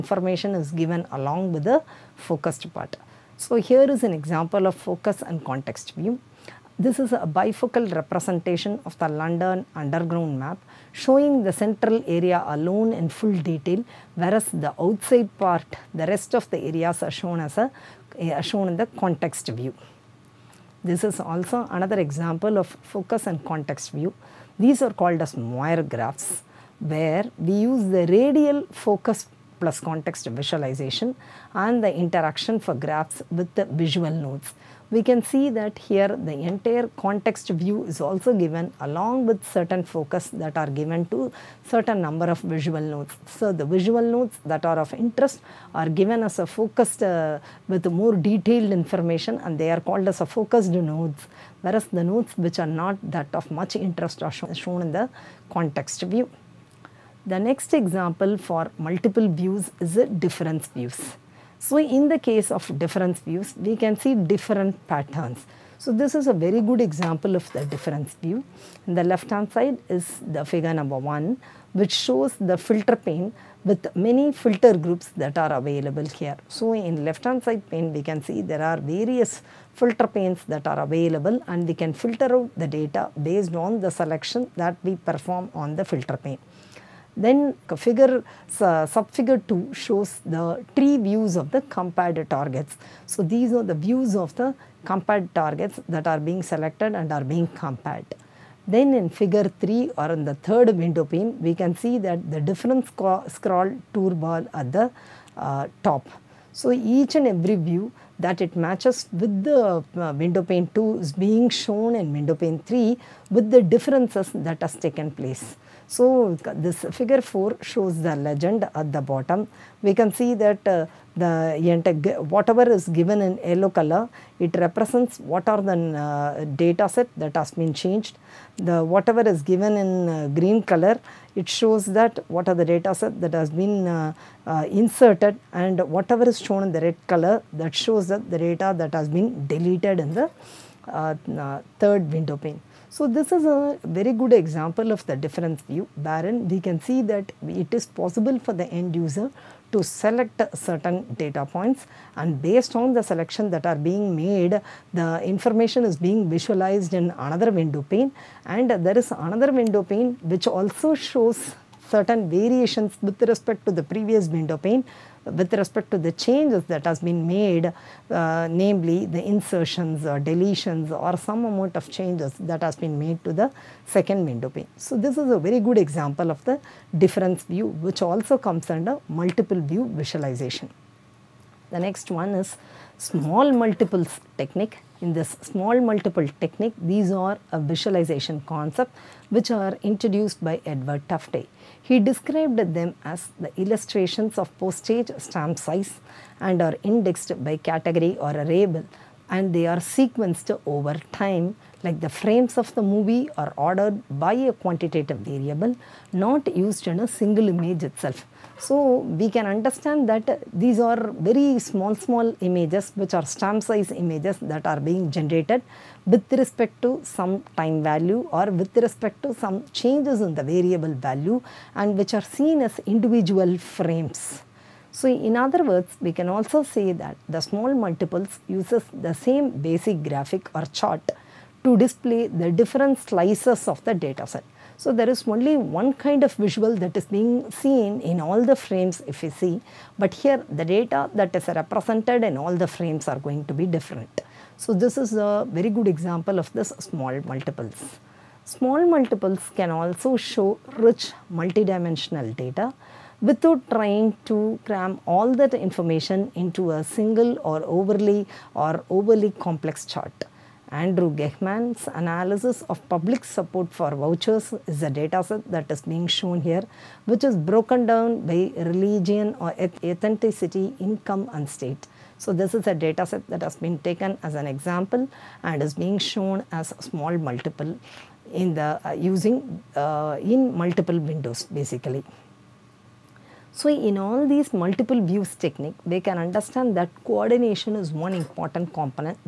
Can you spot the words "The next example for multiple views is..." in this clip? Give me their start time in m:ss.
0:57.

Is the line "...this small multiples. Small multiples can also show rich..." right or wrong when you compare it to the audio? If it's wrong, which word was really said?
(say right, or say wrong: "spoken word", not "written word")
right.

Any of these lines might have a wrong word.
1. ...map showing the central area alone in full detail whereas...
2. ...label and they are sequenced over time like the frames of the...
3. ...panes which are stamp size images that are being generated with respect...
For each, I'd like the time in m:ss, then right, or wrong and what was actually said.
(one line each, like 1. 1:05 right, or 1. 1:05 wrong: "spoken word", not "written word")
1. 0:10 right
2. 3:18 right
3. 3:32 wrong: "images", not "panes".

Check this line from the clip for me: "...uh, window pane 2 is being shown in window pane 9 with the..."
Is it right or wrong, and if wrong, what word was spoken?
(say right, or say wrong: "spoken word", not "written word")
wrong: "3", not "9".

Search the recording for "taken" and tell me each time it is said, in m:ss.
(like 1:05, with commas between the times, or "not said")
1:54, 4:33.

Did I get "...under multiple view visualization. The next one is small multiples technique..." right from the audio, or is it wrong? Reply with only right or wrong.
right.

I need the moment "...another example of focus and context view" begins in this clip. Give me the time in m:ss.
0:21.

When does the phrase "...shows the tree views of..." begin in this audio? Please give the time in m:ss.
1:29.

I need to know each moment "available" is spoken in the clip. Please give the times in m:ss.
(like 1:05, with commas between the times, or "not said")
1:15, 1:20.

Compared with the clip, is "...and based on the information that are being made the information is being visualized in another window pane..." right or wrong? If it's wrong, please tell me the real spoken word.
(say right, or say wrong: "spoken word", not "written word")
wrong: "selection", not "information".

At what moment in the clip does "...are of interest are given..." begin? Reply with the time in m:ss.
0:44.